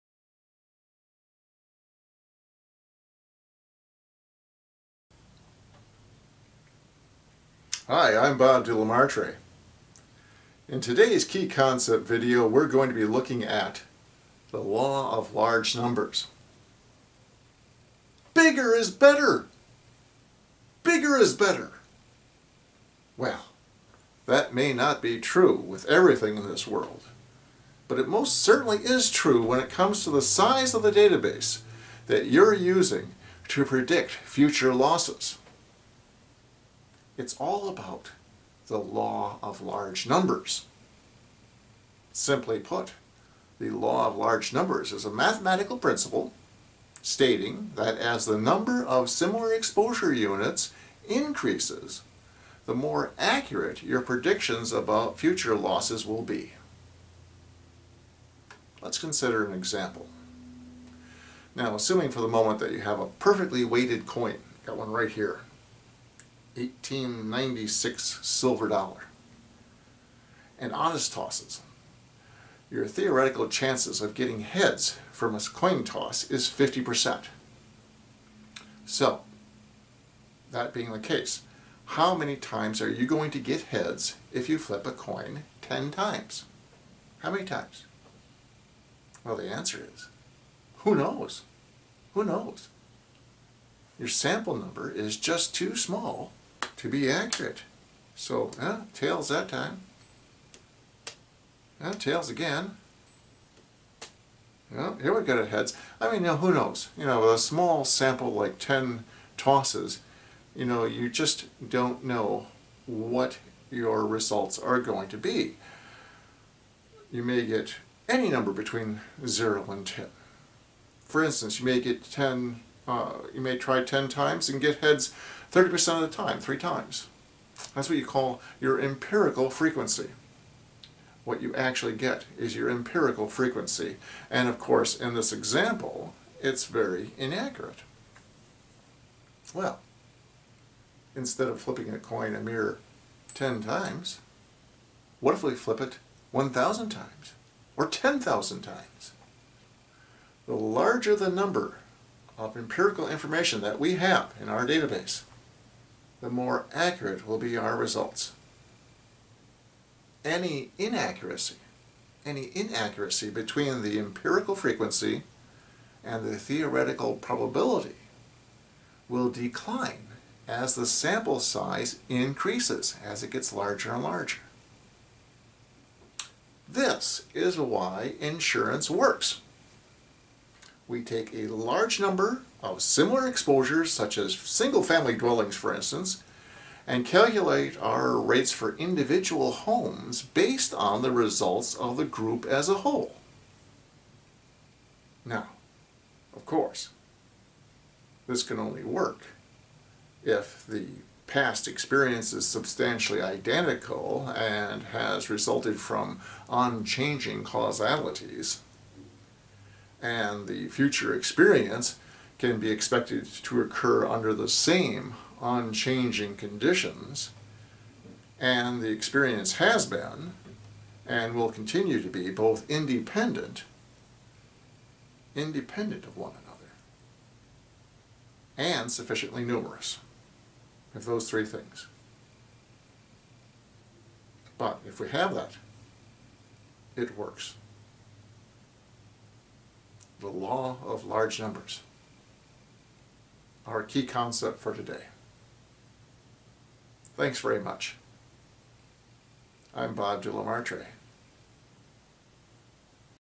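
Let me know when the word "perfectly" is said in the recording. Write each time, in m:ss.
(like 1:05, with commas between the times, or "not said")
1:03.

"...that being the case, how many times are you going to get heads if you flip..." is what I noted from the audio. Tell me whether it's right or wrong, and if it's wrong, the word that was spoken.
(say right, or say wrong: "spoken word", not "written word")
right.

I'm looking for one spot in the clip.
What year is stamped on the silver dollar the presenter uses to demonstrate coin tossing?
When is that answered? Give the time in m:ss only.
1:06.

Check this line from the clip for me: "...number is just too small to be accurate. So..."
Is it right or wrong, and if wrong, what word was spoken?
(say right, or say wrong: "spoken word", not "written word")
right.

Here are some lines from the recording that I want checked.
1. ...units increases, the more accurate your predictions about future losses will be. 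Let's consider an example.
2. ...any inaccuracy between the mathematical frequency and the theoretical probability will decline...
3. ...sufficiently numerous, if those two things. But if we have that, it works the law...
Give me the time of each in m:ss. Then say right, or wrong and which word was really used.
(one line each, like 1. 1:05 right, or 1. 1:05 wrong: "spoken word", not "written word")
1. 0:50 right
2. 2:42 wrong: "empirical", not "mathematical"
3. 3:48 wrong: "three", not "two".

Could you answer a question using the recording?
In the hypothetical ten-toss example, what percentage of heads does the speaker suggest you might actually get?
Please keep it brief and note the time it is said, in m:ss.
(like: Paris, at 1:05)
30%, at 2:05.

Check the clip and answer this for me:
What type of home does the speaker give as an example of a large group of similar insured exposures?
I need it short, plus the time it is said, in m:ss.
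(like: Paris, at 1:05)
single-family dwellings, at 3:04.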